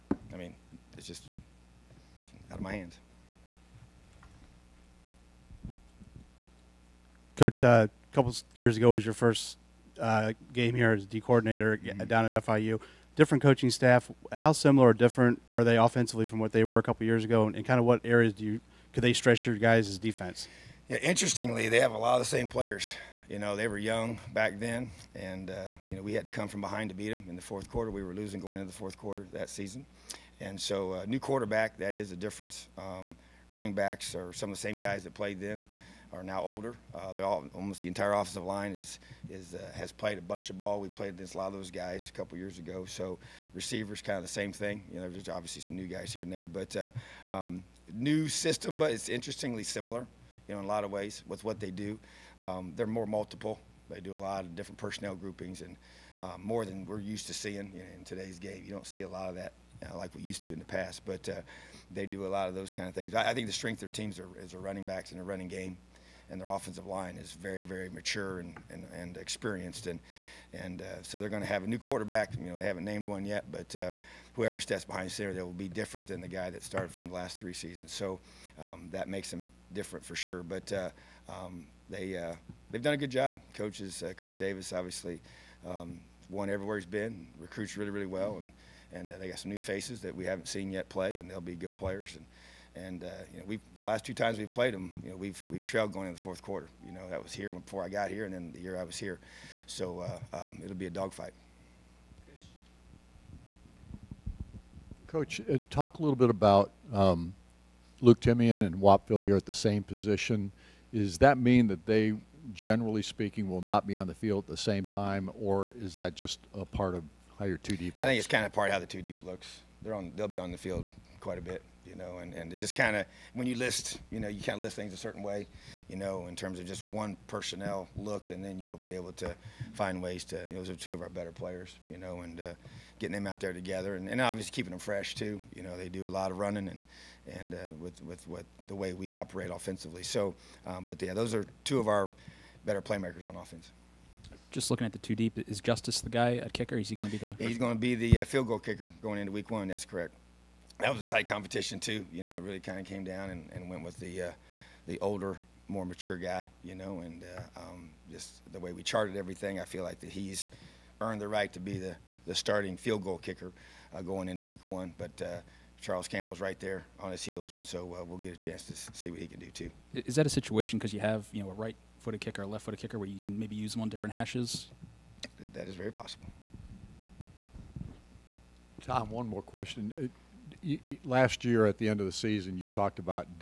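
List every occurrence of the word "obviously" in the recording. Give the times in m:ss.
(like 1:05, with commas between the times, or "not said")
0:45, 1:24, 2:14.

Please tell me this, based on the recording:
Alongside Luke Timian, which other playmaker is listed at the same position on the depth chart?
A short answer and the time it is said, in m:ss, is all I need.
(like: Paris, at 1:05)
Whop Philyor, at 1:48.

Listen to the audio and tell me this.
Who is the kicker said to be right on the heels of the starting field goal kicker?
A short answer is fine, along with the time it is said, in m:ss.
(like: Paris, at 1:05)
Charles Campbell, at 2:45.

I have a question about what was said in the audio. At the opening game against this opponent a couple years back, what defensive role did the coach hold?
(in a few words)
D coordinator.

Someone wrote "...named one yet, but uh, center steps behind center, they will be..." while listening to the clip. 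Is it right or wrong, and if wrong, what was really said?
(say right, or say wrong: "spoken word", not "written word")
wrong: "whoever", not "center".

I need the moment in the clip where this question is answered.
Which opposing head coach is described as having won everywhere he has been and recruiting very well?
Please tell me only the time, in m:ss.
1:24.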